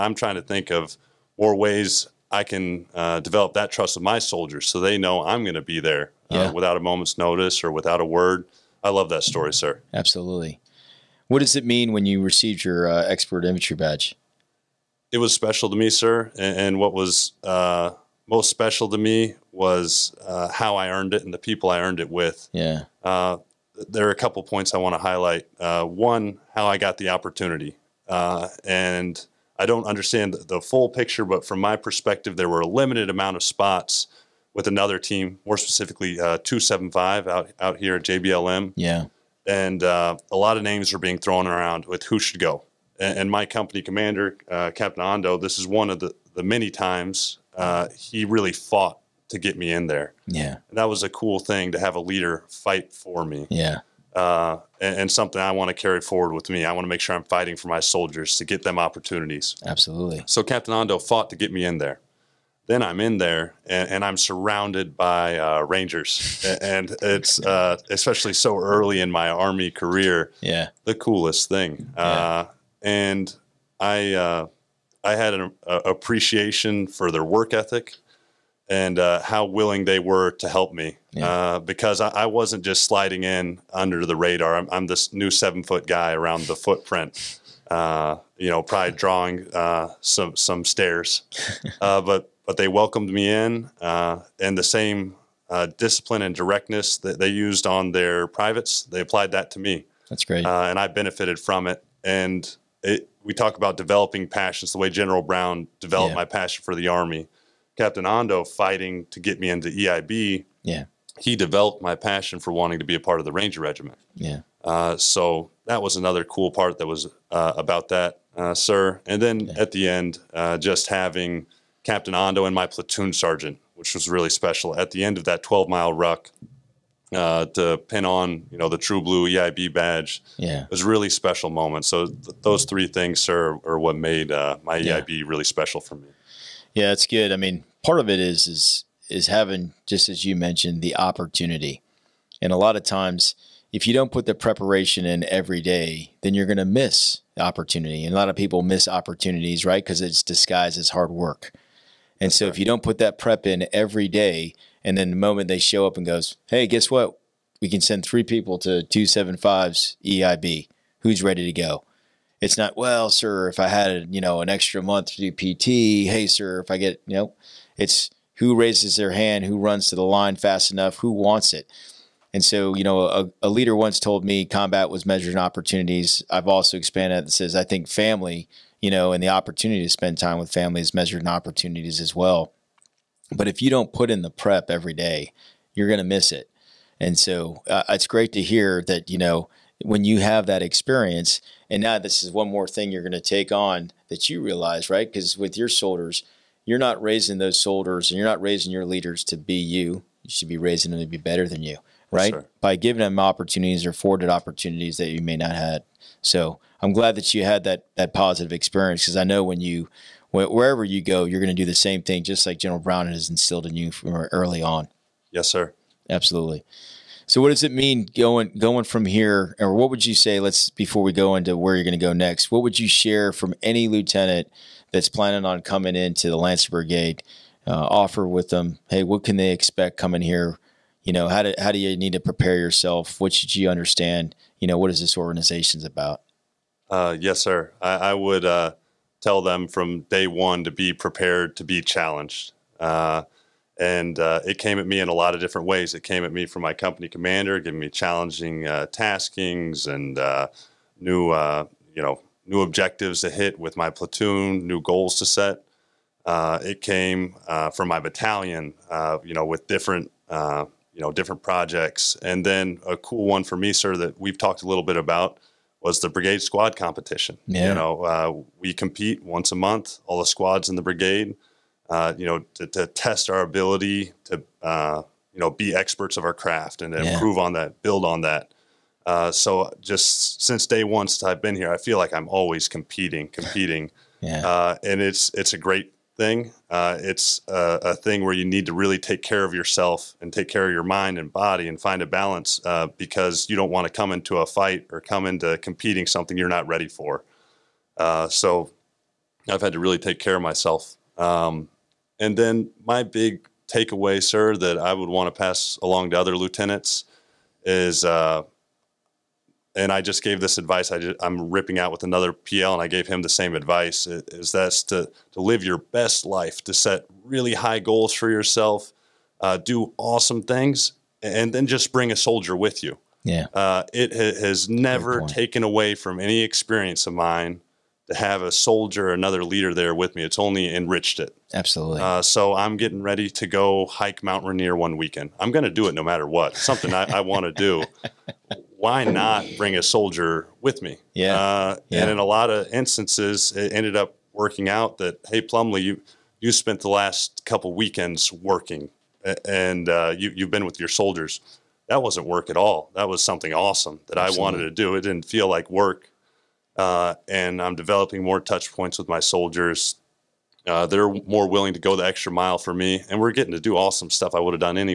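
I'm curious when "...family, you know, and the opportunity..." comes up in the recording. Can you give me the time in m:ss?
2:57.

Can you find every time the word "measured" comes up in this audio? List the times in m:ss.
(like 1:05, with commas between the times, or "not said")
2:55, 3:00.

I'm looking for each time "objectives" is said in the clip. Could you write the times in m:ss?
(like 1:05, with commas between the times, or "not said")
4:12.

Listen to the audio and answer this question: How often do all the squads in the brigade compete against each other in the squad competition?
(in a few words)
once a month.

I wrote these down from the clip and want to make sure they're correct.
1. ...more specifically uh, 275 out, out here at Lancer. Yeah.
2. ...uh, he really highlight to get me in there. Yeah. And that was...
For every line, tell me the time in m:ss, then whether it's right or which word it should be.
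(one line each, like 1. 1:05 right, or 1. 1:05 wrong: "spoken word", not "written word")
1. 0:35 wrong: "JBLM", not "Lancer"
2. 0:47 wrong: "fought", not "highlight".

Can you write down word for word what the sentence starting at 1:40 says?
That's great, and I benefited from it.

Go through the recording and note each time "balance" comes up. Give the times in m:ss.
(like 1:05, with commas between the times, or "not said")
4:52.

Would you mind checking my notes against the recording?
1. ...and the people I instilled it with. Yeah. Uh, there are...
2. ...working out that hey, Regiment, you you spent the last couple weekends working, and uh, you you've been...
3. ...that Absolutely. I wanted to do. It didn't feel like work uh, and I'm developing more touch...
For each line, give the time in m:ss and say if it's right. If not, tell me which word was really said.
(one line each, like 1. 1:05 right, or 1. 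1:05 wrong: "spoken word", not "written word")
1. 0:21 wrong: "earned", not "instilled"
2. 5:44 wrong: "Plumlee", not "Regiment"
3. 5:54 right.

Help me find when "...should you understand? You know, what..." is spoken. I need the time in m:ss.
3:53.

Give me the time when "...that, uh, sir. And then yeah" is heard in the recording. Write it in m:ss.
1:57.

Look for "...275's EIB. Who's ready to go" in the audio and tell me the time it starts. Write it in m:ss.
2:38.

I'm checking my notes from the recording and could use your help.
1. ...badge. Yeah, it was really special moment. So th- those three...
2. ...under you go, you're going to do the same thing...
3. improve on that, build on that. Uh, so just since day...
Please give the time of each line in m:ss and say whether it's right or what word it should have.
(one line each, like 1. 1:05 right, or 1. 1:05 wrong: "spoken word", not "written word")
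1. 2:09 right
2. 3:30 wrong: "wherever", not "under"
3. 4:37 right.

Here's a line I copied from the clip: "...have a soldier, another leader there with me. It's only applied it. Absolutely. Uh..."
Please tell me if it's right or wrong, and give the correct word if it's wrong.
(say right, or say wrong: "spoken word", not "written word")
wrong: "enriched", not "applied".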